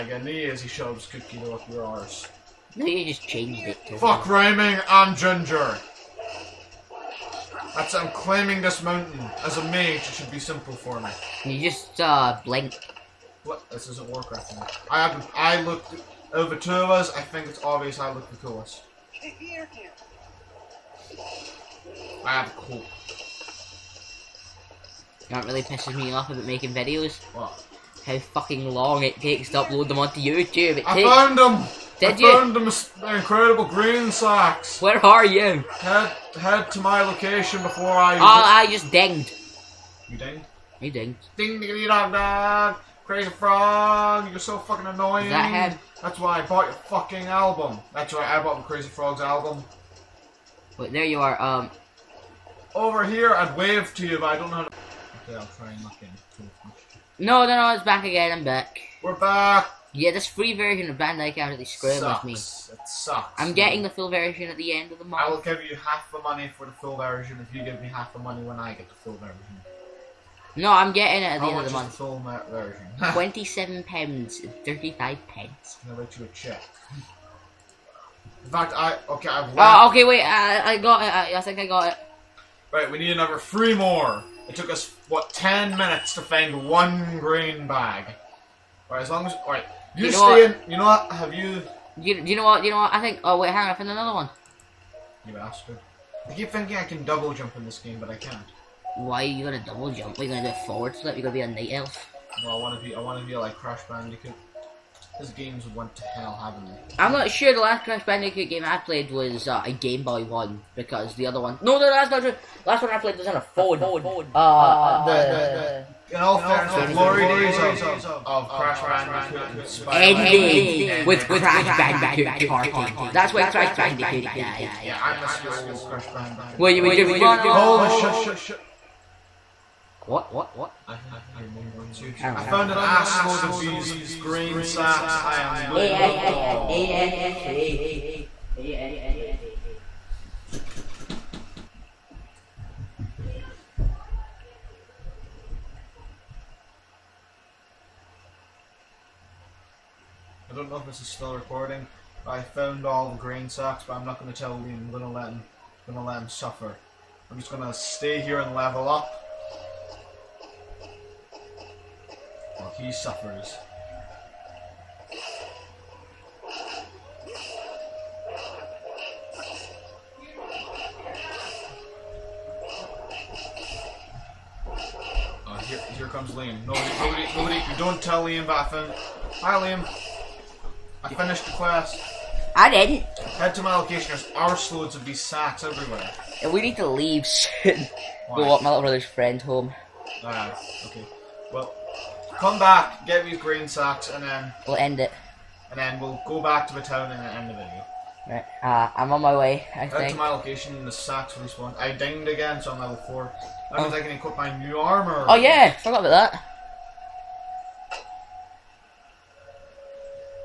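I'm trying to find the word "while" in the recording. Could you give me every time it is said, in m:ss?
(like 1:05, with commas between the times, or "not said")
2:42.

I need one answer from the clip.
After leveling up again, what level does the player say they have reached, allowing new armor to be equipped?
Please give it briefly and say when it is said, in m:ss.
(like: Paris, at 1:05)
4, at 3:22.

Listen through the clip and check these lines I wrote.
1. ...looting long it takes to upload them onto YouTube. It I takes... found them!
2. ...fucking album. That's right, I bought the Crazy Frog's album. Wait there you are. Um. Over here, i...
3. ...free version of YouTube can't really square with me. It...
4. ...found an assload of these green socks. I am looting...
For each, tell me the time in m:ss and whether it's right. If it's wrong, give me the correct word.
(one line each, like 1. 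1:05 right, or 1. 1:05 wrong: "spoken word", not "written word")
1. 0:28 wrong: "fucking", not "looting"
2. 0:46 right
3. 1:00 wrong: "Bandai", not "YouTube"
4. 2:12 right.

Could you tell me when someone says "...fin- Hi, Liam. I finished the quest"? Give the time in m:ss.
2:58.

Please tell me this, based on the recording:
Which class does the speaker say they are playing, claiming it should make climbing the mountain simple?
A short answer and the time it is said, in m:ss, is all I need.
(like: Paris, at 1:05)
Mage, at 0:09.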